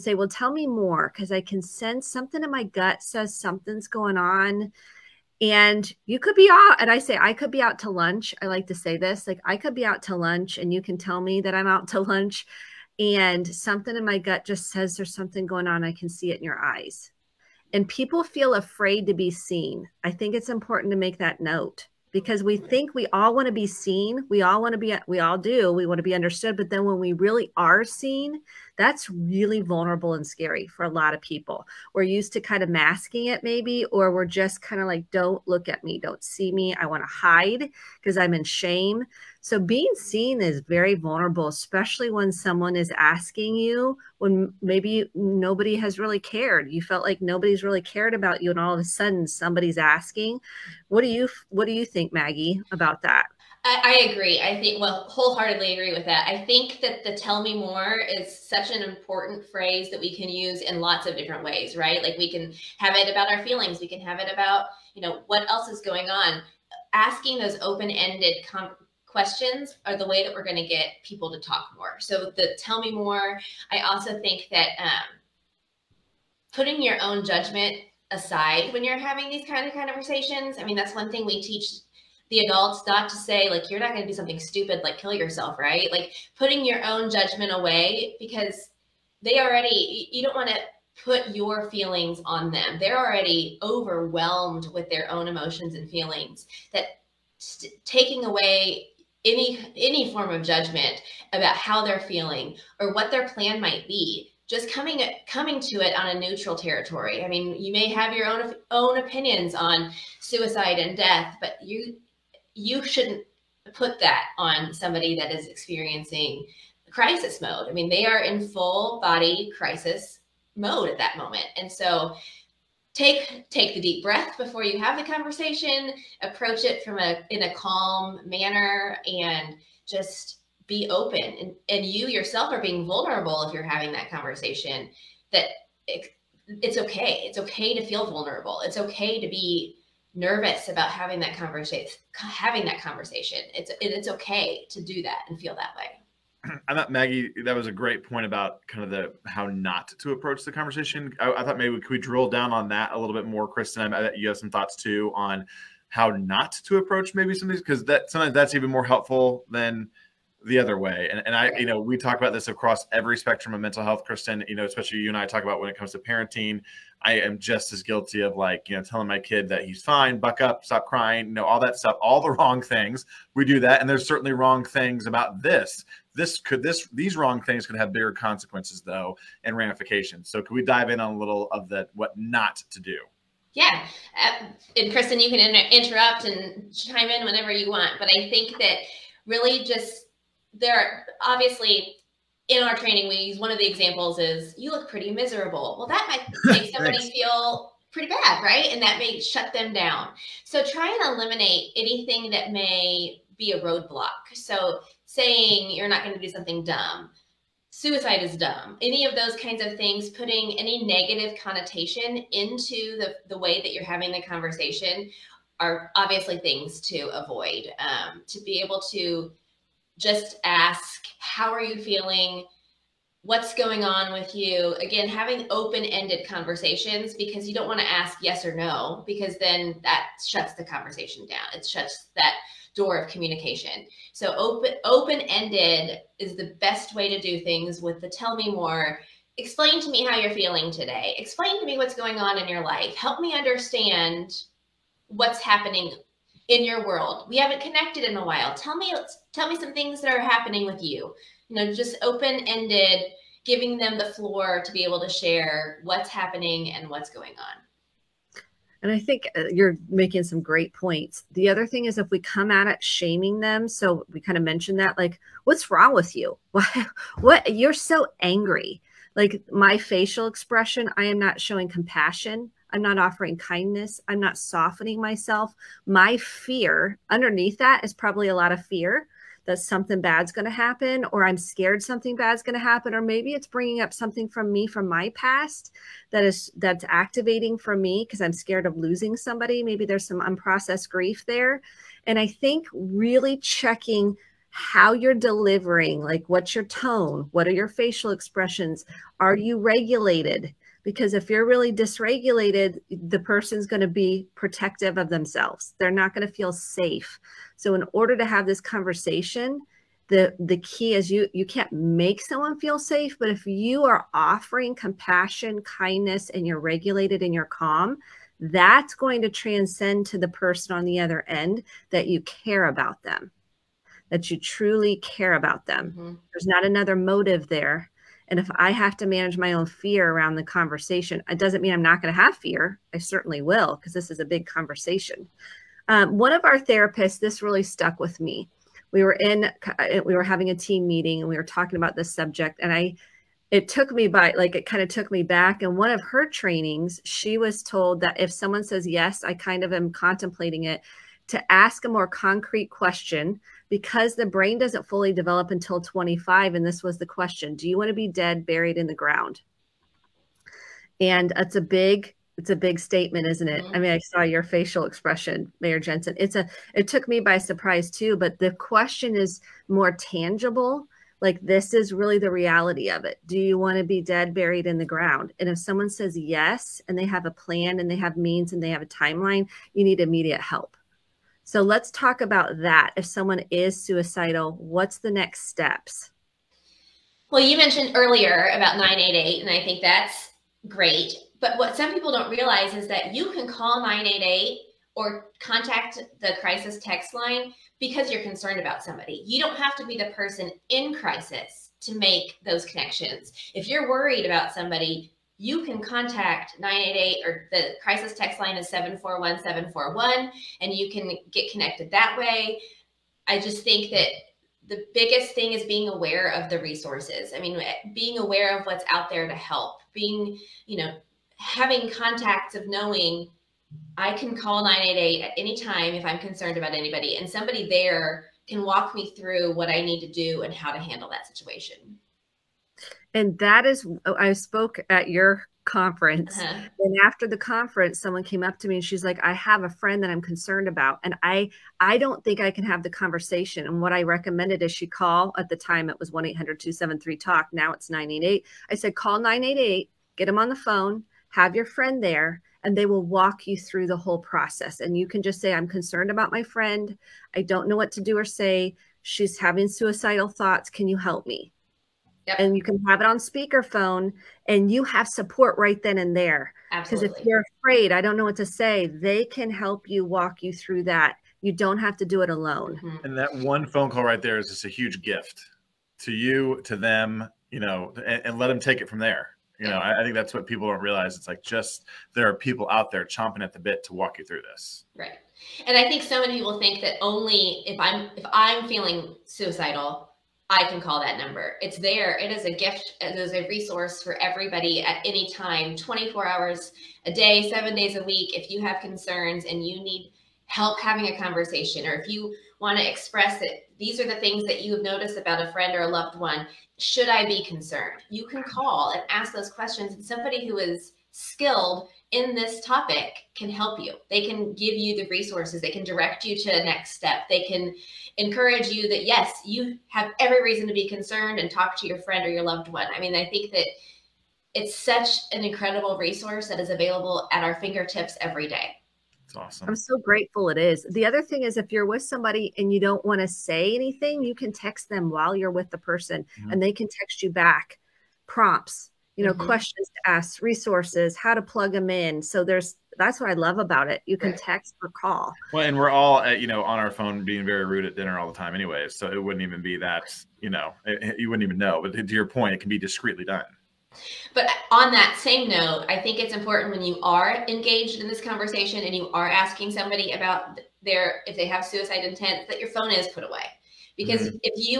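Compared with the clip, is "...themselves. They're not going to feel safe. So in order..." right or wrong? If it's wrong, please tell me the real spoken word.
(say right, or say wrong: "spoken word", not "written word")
right.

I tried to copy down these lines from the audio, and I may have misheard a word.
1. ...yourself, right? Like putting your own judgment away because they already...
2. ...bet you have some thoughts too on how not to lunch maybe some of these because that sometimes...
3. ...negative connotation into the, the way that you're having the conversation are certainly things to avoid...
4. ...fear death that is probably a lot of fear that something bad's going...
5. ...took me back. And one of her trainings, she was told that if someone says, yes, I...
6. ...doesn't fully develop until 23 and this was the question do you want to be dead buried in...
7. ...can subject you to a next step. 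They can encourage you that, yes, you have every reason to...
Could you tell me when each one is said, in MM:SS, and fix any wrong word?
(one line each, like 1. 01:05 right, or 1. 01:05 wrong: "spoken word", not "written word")
1. 01:25 right
2. 02:34 wrong: "approach", not "lunch"
3. 03:30 wrong: "obviously", not "certainly"
4. 04:36 wrong: "underneath", not "death"
5. 05:44 right
6. 05:54 wrong: "25", not "23"
7. 08:35 wrong: "direct", not "subject".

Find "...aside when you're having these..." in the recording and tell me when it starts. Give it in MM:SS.
01:18.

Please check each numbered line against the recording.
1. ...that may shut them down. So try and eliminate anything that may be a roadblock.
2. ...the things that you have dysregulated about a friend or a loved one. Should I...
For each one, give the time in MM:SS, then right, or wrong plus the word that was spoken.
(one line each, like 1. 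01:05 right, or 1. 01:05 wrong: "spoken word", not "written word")
1. 03:18 right
2. 08:24 wrong: "noticed", not "dysregulated".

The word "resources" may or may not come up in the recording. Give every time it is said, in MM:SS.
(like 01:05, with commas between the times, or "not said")
06:56, 08:13, 08:35, 08:45, 09:00.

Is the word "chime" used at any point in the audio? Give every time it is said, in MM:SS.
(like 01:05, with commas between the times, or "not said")
03:06.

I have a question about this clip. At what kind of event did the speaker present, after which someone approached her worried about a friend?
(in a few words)
Your conference.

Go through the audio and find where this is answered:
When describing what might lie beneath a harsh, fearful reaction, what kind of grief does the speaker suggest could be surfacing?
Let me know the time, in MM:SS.
04:50.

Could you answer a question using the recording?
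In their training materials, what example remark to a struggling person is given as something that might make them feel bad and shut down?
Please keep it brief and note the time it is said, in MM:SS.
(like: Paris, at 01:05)
You look pretty miserable, at 03:14.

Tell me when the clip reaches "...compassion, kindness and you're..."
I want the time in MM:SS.
05:14.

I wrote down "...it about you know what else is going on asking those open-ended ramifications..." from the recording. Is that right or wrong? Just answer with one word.
wrong.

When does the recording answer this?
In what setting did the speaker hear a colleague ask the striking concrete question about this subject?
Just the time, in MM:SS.
05:40.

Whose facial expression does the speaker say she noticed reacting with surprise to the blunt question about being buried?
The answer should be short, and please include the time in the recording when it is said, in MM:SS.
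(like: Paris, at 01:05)
Mayor Jenson, at 06:05.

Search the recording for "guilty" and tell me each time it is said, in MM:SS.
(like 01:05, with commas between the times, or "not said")
02:47.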